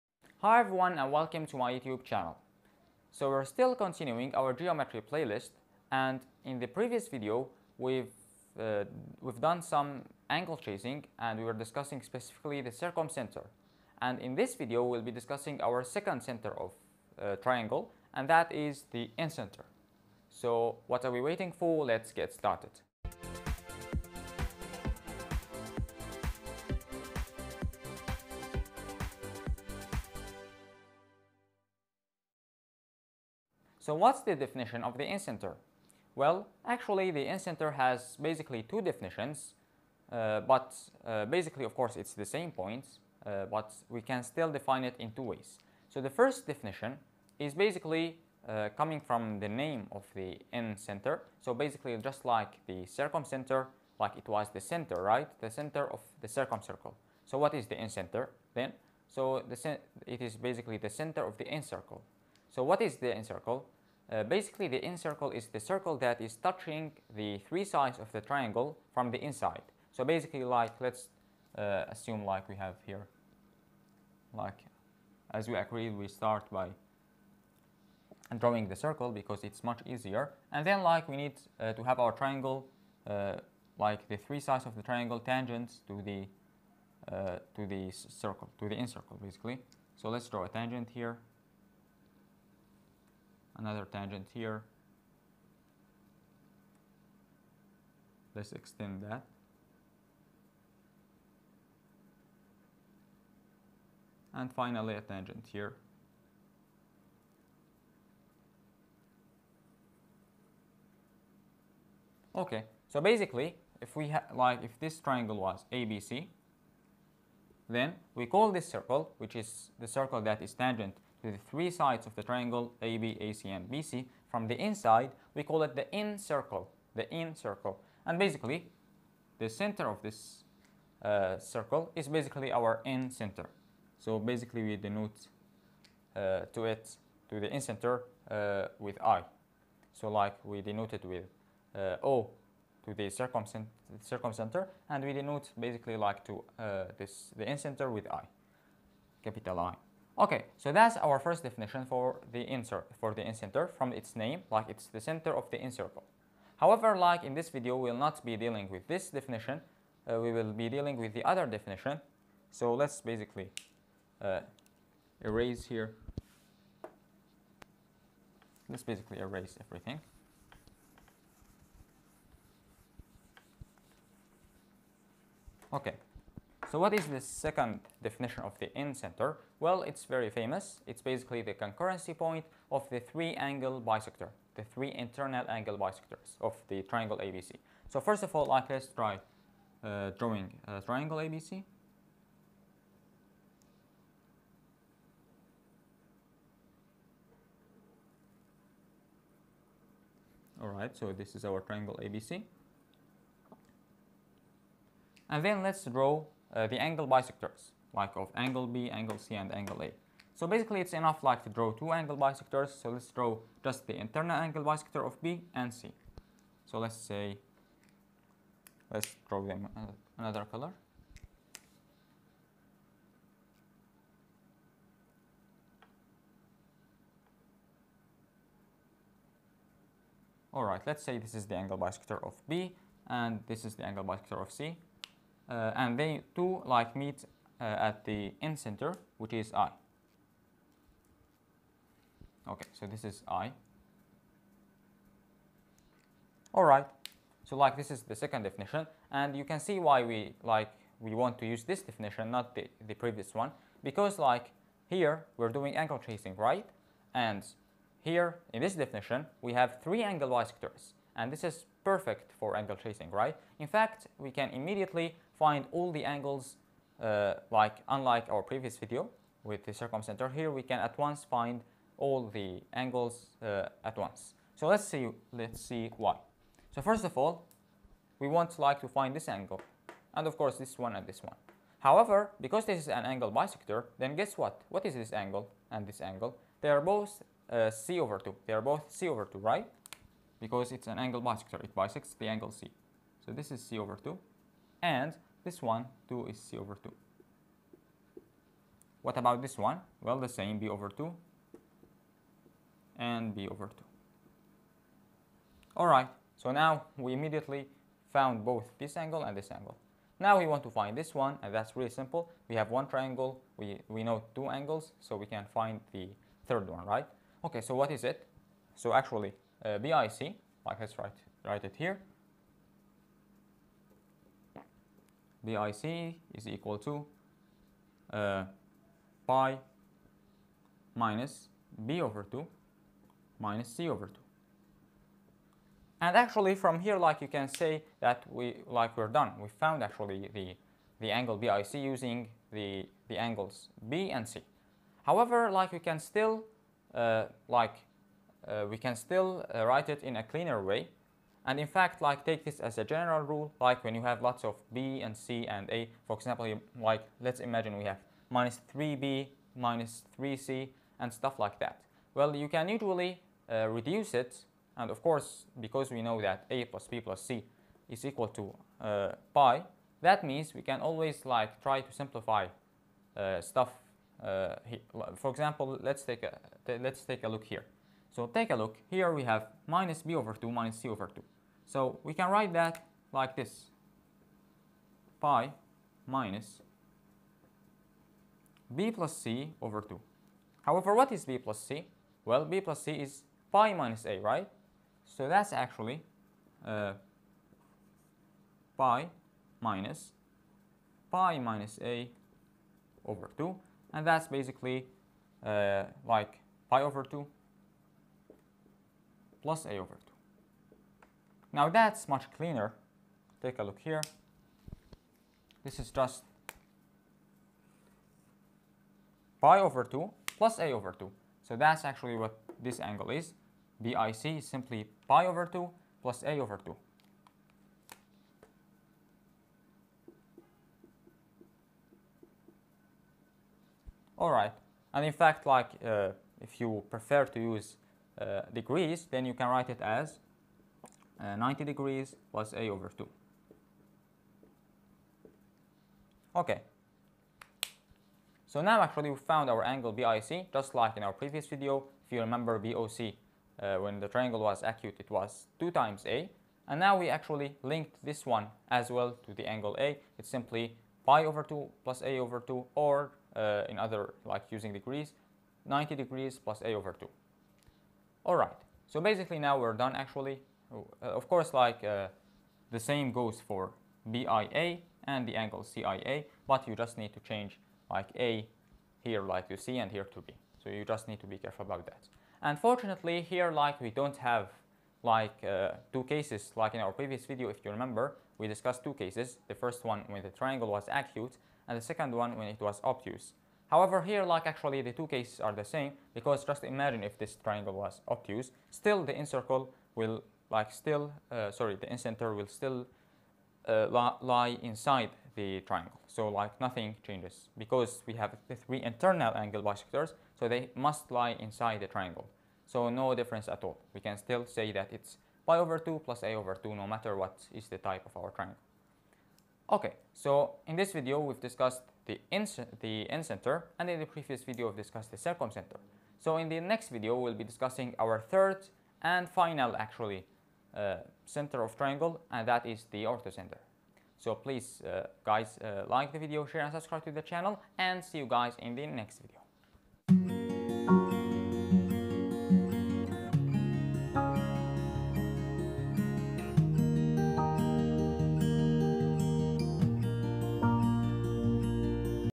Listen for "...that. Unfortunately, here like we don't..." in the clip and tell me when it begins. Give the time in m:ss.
8:01.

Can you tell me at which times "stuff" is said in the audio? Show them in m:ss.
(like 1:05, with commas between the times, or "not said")
6:01, 6:13.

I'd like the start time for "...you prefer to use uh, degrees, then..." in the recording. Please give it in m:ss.
7:16.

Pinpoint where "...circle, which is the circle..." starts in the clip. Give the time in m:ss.
1:58.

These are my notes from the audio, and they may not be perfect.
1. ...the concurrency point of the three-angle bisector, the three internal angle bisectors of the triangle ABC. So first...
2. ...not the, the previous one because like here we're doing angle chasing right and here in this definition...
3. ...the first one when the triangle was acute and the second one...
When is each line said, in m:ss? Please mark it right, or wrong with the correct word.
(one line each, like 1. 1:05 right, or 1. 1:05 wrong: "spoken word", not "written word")
1. 3:01 right
2. 4:12 right
3. 8:09 right.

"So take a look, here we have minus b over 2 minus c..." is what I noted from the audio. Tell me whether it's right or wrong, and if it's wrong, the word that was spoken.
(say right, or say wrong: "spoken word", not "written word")
right.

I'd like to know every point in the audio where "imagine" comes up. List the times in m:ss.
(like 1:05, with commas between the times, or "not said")
5:57, 8:16.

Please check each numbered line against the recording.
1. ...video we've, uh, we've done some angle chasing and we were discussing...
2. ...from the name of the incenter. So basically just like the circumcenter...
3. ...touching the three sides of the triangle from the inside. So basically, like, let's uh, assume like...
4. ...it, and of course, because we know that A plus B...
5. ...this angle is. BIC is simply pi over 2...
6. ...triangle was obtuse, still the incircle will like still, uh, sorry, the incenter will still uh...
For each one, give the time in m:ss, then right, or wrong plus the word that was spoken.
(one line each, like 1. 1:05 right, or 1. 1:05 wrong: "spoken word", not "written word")
1. 0:07 right
2. 0:49 right
3. 1:06 right
4. 6:04 right
5. 7:02 right
6. 8:17 right.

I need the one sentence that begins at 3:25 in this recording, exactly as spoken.
And then let's draw uh, the angle bisectors, like of angle B, angle C, and angle A.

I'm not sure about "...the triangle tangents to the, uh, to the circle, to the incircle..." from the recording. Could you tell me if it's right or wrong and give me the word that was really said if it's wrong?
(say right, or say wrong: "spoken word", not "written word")
right.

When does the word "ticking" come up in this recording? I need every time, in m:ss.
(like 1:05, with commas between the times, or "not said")
not said.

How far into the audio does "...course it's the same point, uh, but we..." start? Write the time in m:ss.
0:41.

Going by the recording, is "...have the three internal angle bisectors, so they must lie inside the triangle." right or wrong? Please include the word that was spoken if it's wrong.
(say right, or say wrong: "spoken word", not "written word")
right.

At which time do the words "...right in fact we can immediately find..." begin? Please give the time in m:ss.
4:23.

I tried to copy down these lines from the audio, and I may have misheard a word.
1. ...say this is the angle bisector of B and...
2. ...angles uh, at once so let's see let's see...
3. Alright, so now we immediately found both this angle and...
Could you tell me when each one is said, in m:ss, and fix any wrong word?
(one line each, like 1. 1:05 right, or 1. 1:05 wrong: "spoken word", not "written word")
1. 3:51 right
2. 4:32 right
3. 5:05 right.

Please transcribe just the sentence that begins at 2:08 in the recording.
And basically, the center of this uh, circle is basically our in center.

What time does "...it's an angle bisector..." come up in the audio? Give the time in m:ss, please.
4:50.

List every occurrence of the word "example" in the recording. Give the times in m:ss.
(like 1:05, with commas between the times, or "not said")
5:56, 6:15.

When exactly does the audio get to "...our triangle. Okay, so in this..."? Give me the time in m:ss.
8:38.